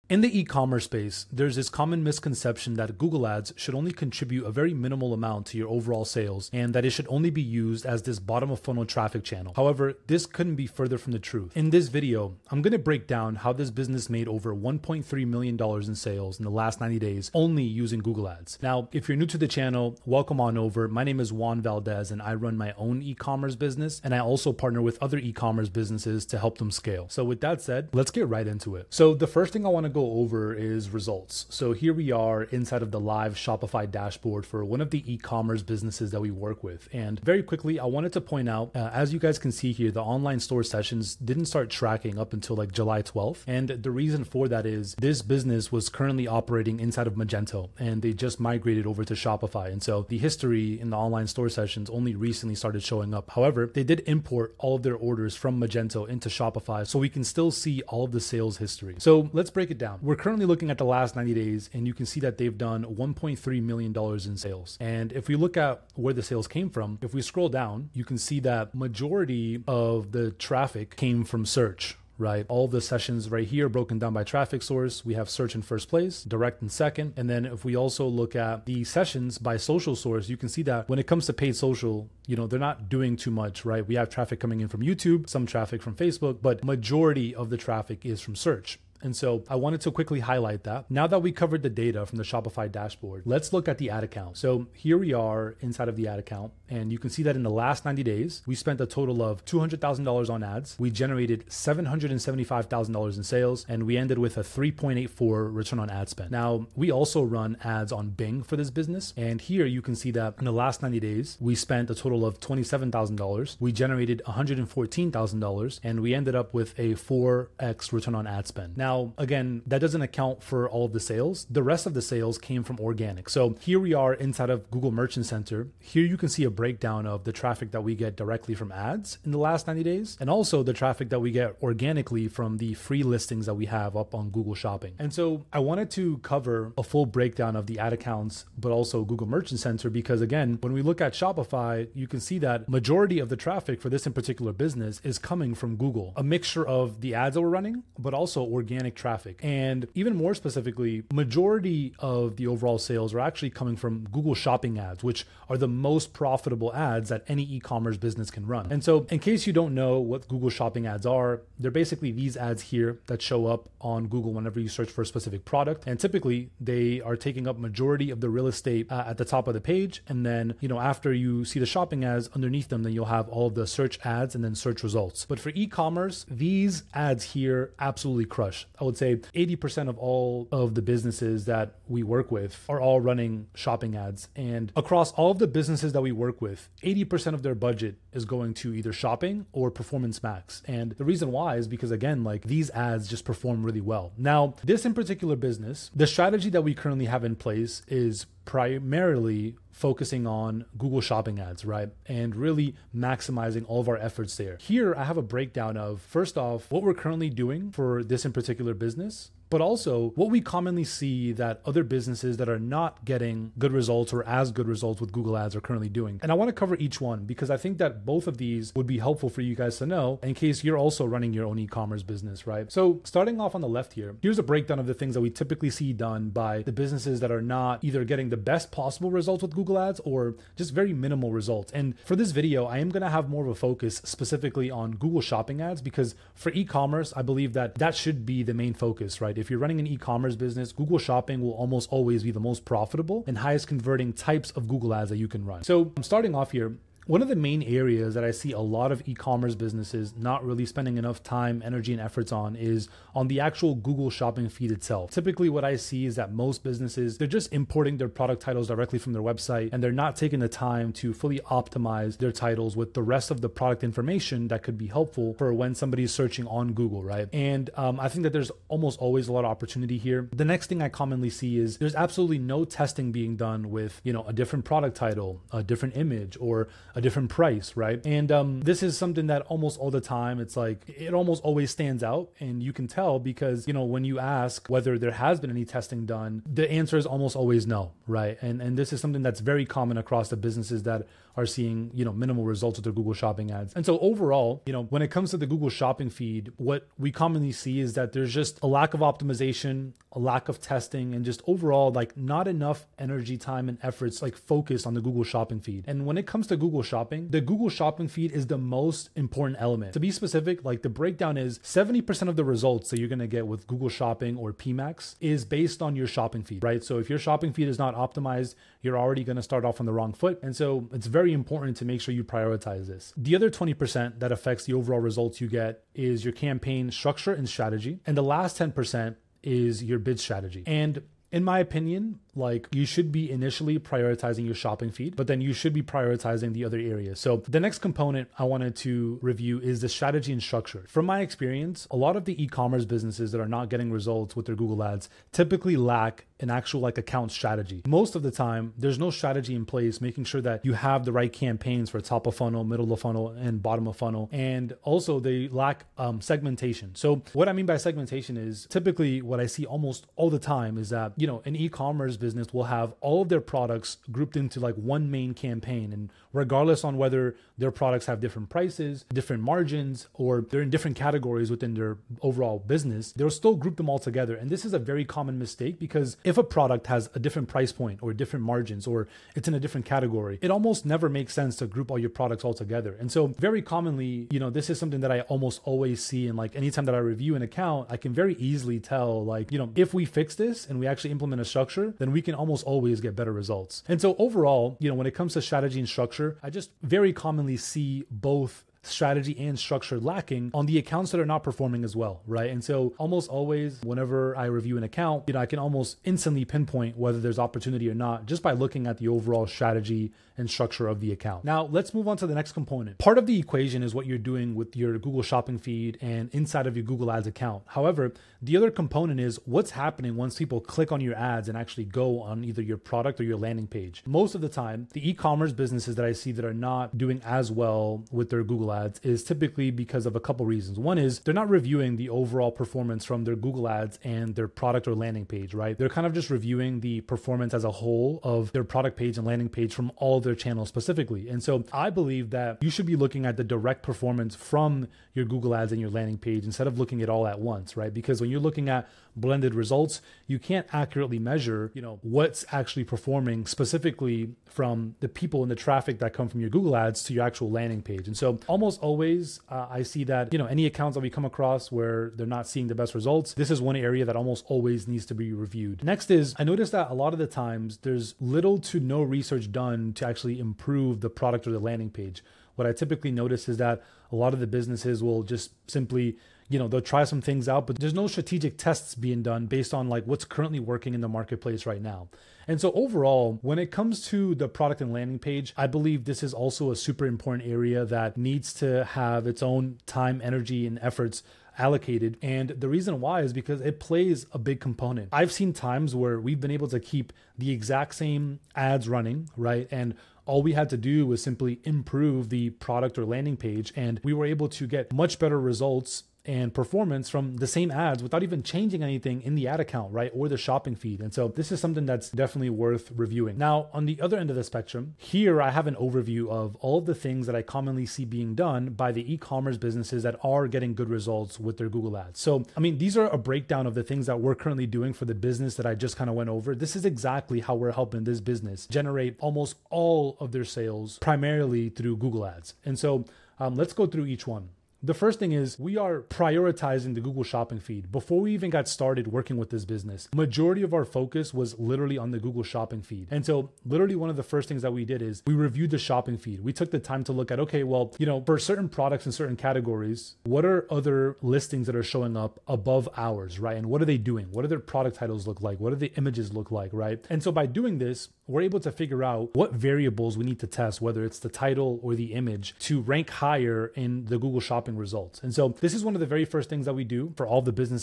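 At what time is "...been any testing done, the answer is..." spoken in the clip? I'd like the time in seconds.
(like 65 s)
285 s.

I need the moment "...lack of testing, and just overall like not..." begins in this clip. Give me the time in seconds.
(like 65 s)
300 s.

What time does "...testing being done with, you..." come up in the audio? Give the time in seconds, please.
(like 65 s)
272 s.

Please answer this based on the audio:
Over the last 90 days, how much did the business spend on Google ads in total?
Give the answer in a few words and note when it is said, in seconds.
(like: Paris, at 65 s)
$200,000, at 99 s.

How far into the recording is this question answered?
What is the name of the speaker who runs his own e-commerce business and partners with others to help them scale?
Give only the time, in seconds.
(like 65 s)
21 s.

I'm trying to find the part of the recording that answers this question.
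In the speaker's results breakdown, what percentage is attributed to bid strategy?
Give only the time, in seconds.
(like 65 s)
328 s.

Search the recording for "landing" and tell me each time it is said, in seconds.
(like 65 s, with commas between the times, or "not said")
423 s, 434 s, 439 s, 445 s, 457 s, 471 s, 484 s, 503 s.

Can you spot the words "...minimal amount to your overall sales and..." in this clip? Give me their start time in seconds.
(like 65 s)
4 s.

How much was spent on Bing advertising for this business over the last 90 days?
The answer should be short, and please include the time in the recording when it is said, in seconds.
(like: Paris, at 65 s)
$27,000, at 112 s.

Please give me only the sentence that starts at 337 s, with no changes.
So the next component I wanted to review is the strategy and structure.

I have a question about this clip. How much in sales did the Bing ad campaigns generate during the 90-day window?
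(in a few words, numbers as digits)
$114,000.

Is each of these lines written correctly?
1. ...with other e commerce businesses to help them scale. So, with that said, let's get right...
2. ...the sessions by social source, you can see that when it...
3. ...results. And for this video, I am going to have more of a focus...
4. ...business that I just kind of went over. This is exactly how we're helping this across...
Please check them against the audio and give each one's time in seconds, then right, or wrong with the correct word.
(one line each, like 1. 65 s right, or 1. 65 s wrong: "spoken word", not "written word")
1. 24 s right
2. 78 s right
3. 231 s right
4. 525 s wrong: "business", not "across".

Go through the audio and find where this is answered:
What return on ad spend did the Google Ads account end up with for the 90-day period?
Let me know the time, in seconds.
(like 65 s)
104 s.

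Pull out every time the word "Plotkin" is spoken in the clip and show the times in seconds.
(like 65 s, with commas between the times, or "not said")
not said.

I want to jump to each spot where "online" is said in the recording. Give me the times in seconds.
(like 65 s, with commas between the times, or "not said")
40 s, 50 s.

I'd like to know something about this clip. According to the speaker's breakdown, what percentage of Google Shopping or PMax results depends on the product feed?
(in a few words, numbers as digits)
70%.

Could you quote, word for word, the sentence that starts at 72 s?
All the sessions right here broken down by traffic source.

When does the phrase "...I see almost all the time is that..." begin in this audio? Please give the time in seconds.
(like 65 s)
359 s.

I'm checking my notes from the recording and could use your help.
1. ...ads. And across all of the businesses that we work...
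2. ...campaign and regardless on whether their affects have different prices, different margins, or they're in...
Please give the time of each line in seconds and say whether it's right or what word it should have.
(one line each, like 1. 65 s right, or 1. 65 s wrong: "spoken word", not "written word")
1. 183 s right
2. 365 s wrong: "products", not "affects".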